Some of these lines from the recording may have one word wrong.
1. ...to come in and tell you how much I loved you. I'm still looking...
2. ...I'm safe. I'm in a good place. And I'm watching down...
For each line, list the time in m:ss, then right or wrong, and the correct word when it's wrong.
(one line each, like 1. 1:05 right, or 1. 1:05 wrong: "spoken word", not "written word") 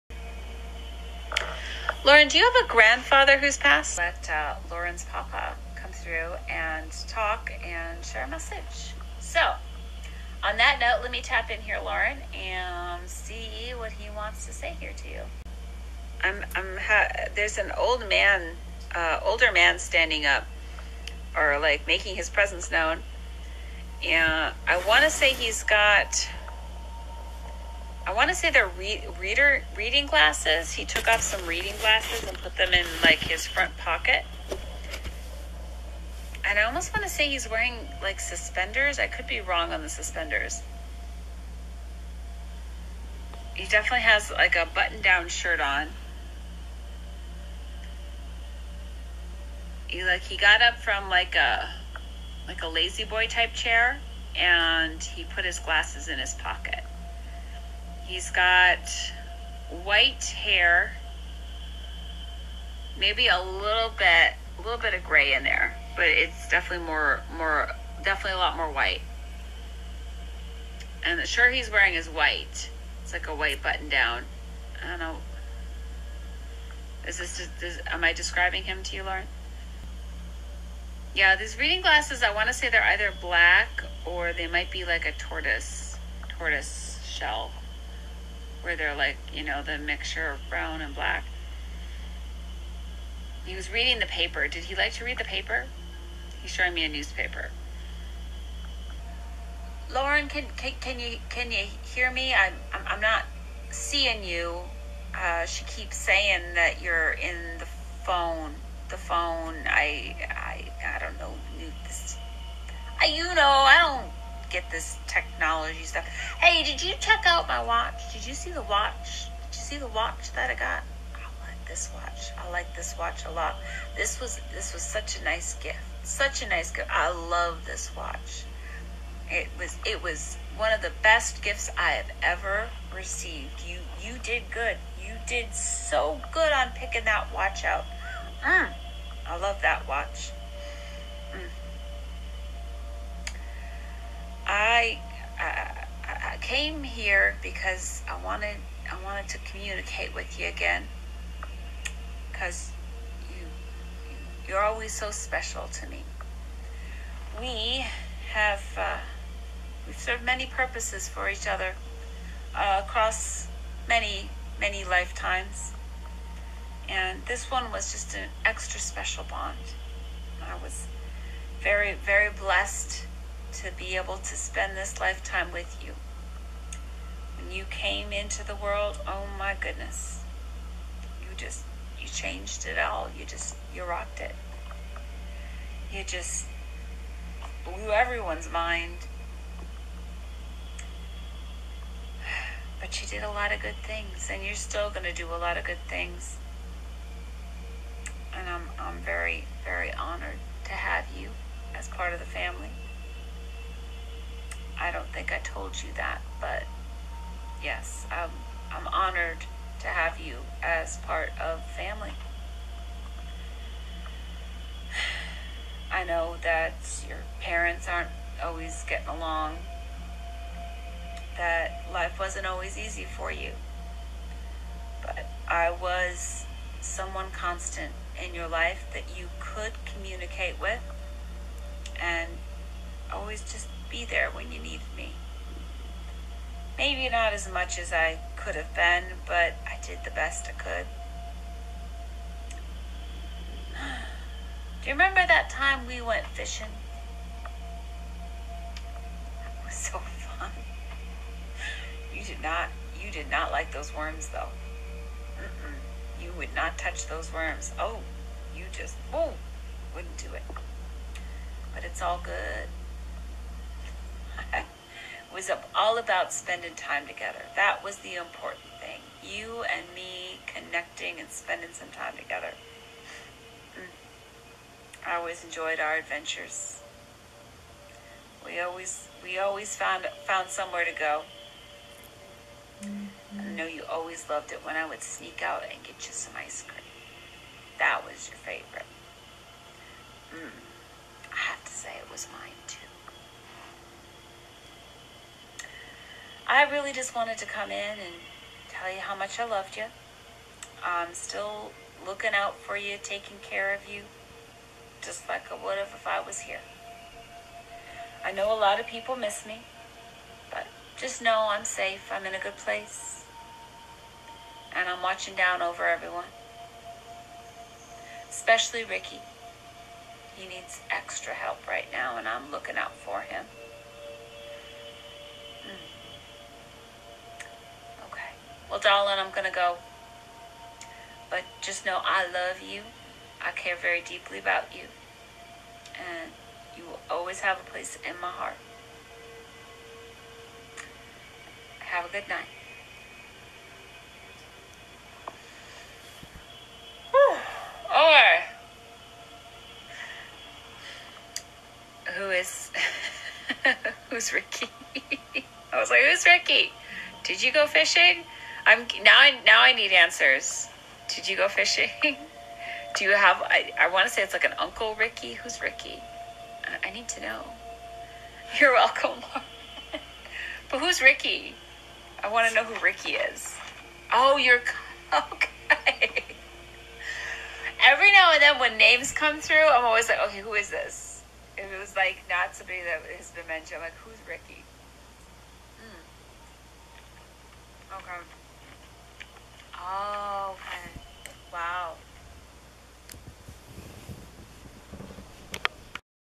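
1. 4:57 right
2. 5:11 right.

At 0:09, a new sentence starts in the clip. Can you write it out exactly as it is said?
So, on that note, let me tap in here, Lauren, and see what he wants to say here to you.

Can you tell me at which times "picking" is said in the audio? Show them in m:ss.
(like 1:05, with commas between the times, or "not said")
2:16.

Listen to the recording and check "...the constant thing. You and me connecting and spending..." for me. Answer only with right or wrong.
wrong.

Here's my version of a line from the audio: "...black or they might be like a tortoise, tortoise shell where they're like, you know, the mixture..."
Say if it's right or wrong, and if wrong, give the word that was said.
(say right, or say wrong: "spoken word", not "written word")
right.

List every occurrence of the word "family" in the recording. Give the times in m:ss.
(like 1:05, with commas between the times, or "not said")
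3:22, 3:31.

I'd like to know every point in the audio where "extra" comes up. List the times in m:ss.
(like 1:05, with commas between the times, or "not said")
2:48, 5:20.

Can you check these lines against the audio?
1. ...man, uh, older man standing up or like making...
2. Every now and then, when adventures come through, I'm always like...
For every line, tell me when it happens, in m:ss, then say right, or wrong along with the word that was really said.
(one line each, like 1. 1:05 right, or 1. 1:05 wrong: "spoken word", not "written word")
1. 0:18 right
2. 6:17 wrong: "names", not "adventures".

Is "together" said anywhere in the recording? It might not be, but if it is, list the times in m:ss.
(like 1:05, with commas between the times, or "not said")
4:27, 4:32.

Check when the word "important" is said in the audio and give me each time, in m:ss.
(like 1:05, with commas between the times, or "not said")
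4:28.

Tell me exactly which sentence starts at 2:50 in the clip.
I was very very blessed to be able to spend this lifetime with you.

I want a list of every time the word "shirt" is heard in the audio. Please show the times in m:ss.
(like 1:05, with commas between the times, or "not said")
0:45, 1:11.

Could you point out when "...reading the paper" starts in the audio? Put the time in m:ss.
1:33.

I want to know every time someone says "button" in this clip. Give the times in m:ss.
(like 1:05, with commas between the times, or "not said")
0:44, 1:13.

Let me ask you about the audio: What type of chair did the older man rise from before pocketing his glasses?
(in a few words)
La-Z-Boy.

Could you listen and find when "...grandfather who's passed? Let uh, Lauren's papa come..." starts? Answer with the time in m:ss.
0:02.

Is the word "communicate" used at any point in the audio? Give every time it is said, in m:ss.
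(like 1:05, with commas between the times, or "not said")
2:29, 3:49.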